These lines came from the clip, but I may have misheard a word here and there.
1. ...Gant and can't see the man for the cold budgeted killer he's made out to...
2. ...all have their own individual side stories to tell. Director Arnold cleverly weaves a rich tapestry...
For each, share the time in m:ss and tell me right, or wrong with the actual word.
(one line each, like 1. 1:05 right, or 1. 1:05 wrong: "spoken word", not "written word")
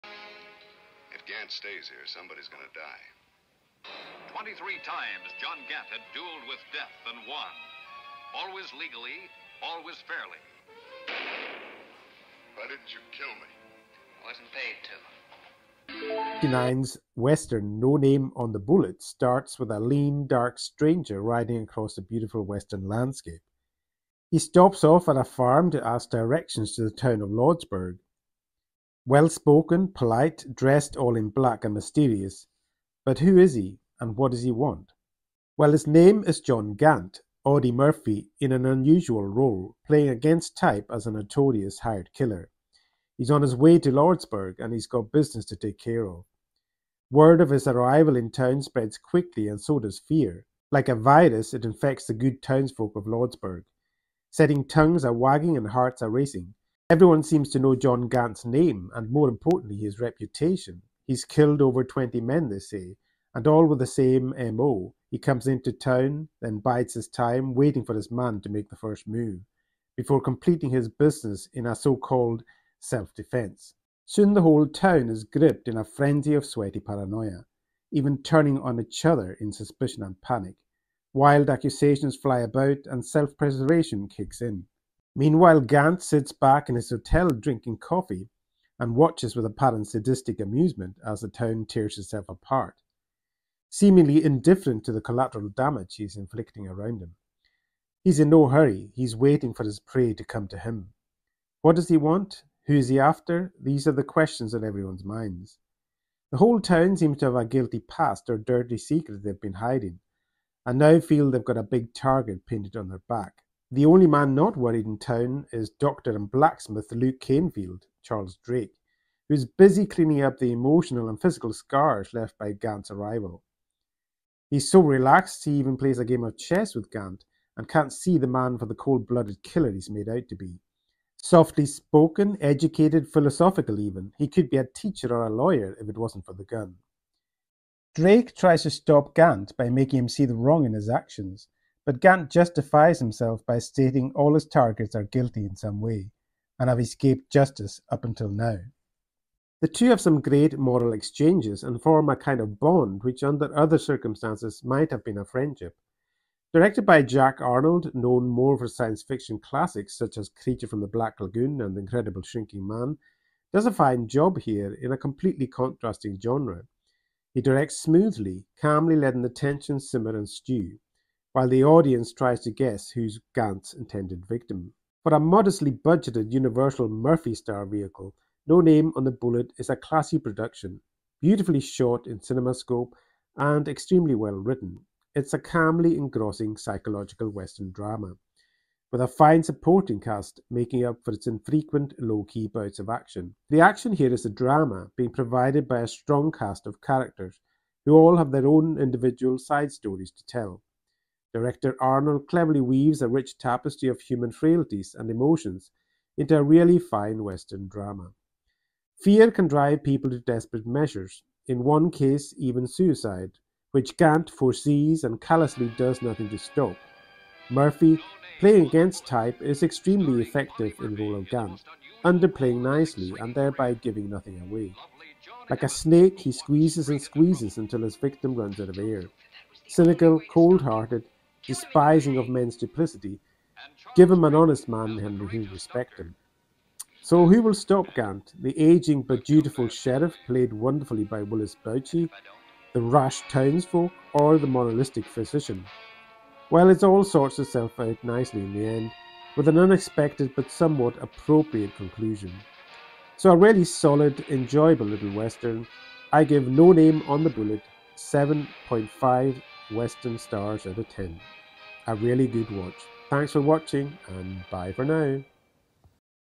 1. 2:06 wrong: "blooded", not "budgeted"
2. 3:17 right.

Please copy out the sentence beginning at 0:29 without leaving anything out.
Well-spoken, polite, dressed all in black and mysterious.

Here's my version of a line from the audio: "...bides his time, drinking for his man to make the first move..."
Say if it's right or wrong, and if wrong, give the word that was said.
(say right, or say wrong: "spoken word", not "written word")
wrong: "waiting", not "drinking".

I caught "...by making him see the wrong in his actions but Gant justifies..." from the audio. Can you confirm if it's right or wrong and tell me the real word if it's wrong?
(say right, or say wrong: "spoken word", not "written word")
right.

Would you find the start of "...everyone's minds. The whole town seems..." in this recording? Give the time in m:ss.
1:44.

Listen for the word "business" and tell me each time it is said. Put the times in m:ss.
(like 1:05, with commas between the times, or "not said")
0:45, 1:10.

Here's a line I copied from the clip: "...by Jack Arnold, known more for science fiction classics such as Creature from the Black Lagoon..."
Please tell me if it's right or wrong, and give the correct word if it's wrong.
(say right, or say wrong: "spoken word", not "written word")
right.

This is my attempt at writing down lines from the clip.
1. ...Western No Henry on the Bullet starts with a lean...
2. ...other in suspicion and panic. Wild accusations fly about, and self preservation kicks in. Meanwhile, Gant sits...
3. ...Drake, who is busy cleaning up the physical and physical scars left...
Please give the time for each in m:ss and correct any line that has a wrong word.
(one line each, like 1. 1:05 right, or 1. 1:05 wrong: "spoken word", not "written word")
1. 0:17 wrong: "Name", not "Henry"
2. 1:19 right
3. 1:58 wrong: "emotional", not "physical".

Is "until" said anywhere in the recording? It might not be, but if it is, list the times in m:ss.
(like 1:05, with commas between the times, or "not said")
2:28, 3:47.